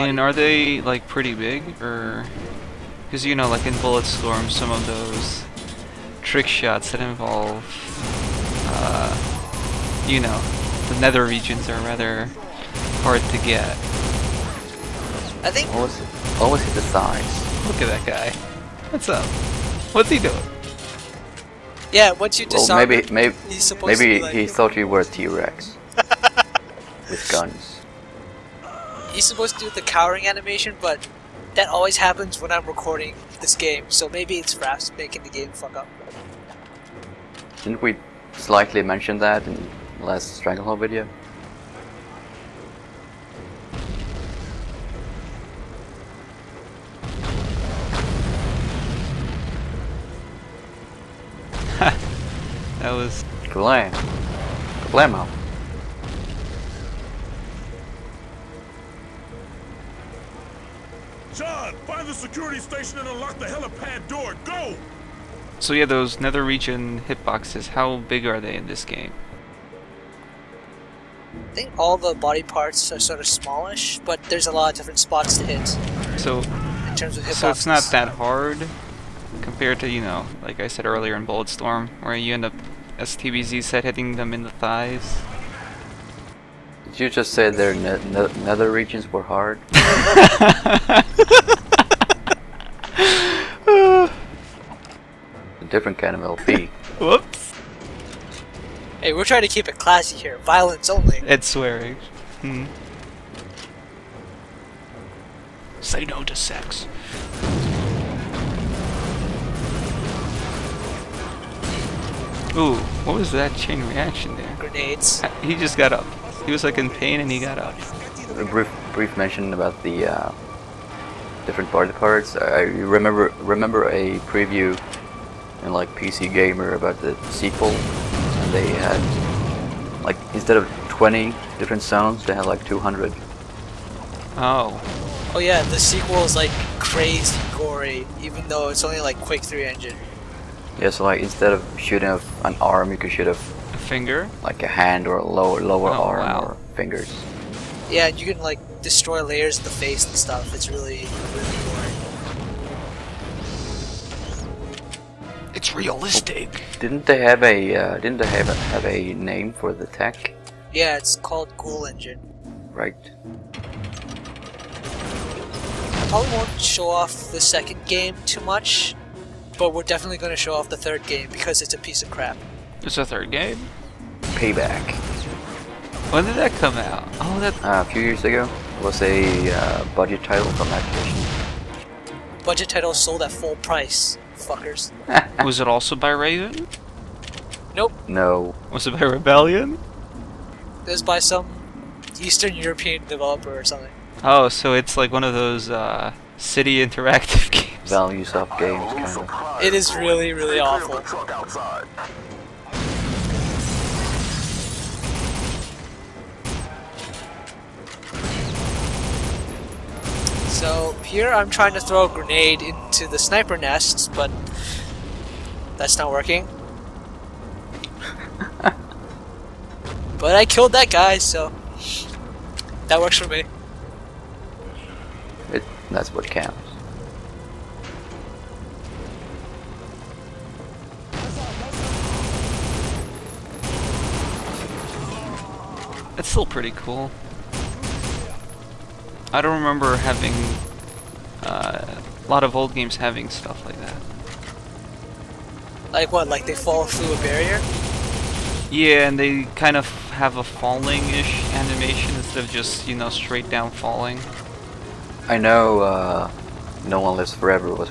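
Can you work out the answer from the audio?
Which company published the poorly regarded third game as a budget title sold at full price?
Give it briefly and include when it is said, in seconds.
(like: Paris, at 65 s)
Activision, at 180 s.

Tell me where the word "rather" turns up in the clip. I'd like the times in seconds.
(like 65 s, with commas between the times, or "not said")
11 s.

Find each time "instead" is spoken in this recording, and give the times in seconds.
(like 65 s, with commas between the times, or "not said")
130 s, 141 s, 252 s.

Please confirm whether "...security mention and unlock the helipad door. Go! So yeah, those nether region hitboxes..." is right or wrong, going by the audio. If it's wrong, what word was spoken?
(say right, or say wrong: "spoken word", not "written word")
wrong: "station", not "mention".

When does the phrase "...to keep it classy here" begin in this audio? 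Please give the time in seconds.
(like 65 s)
99 s.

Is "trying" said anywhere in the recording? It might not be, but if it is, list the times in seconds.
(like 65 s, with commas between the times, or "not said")
99 s, 211 s.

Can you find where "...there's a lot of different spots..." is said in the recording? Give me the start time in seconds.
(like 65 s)
74 s.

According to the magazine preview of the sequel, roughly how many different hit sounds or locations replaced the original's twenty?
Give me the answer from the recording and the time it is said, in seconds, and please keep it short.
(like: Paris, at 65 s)
200, at 132 s.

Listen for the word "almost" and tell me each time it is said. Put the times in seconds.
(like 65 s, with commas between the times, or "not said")
16 s.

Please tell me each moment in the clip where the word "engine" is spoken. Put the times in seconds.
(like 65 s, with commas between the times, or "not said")
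139 s, 161 s.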